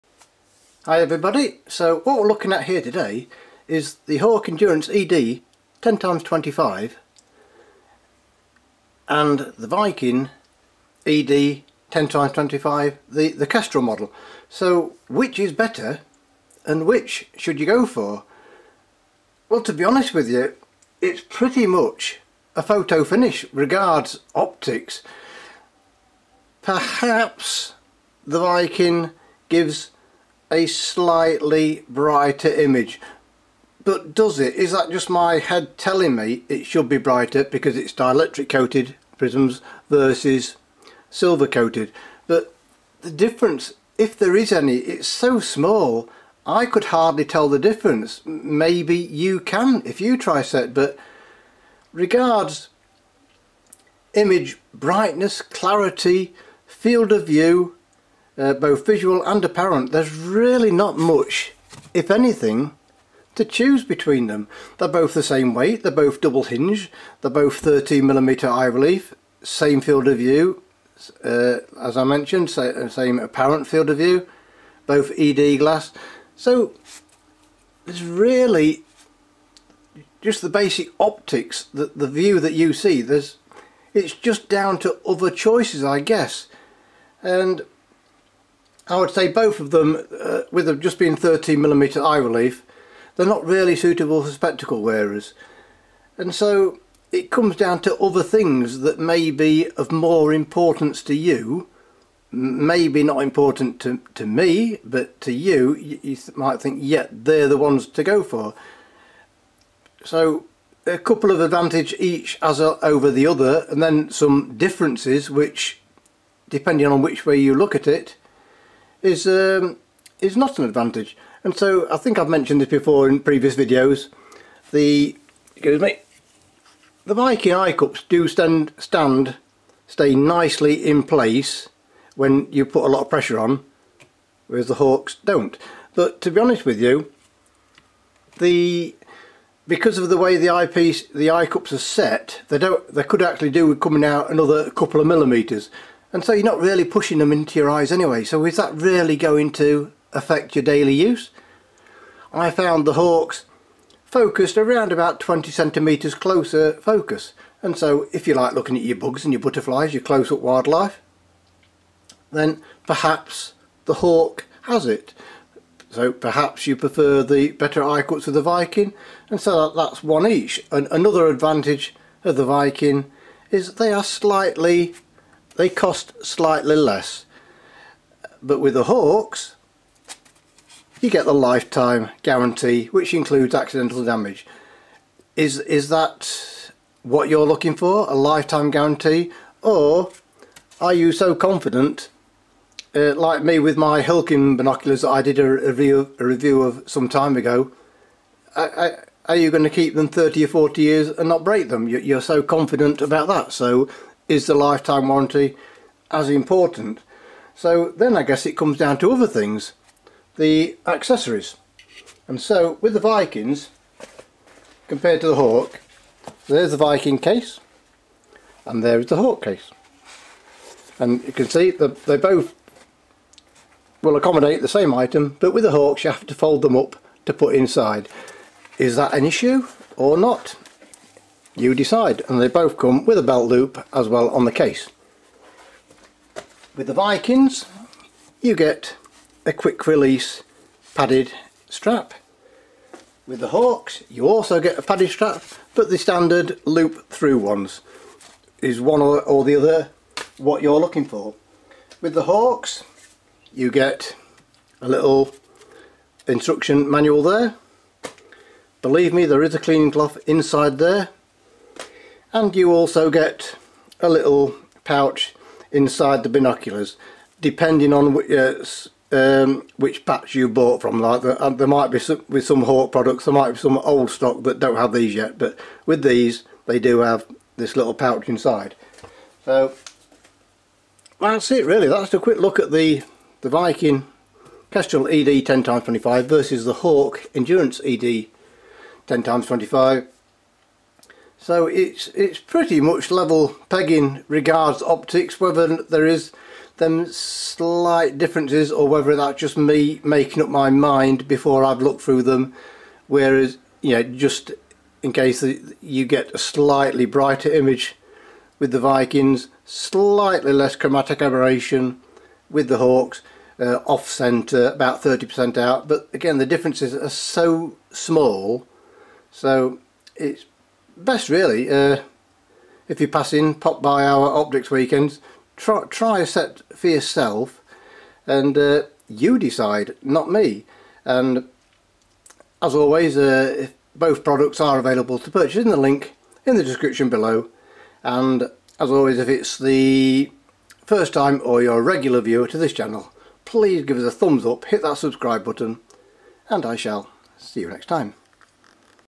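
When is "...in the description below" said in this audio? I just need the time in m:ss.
5:36.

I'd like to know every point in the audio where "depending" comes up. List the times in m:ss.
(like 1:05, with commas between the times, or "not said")
1:56, 4:27.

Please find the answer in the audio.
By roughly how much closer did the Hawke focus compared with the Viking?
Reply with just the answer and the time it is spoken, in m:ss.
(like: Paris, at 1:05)
20 centimeters, at 2:35.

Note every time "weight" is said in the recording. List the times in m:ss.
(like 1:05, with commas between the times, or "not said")
1:05.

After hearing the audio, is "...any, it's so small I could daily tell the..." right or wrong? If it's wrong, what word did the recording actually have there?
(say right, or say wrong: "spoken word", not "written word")
wrong: "hardly", not "daily".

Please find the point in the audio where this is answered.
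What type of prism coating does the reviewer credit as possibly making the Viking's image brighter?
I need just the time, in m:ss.
0:37.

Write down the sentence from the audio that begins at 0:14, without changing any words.
So which is better and which should you go for?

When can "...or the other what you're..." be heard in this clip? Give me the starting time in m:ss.
4:09.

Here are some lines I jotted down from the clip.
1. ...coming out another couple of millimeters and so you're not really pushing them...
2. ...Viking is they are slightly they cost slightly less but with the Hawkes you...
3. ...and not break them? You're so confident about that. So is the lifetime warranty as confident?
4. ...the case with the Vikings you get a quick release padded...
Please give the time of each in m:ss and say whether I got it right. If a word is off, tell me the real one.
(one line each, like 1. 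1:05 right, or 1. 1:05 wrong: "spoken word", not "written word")
1. 2:23 right
2. 2:52 right
3. 3:21 wrong: "important", not "confident"
4. 3:54 right.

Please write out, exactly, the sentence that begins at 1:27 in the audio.
And I would say both of them, uh, with them just being 13mm eye relief, they're not really suitable for spectacle wearers.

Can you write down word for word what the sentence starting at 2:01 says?
And so I think I've mentioned this before in previous videos.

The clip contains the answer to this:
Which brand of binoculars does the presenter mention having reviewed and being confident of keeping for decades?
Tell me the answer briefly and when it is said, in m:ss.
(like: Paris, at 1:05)
Hilkin, at 3:14.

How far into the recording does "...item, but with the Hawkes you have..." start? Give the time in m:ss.
3:44.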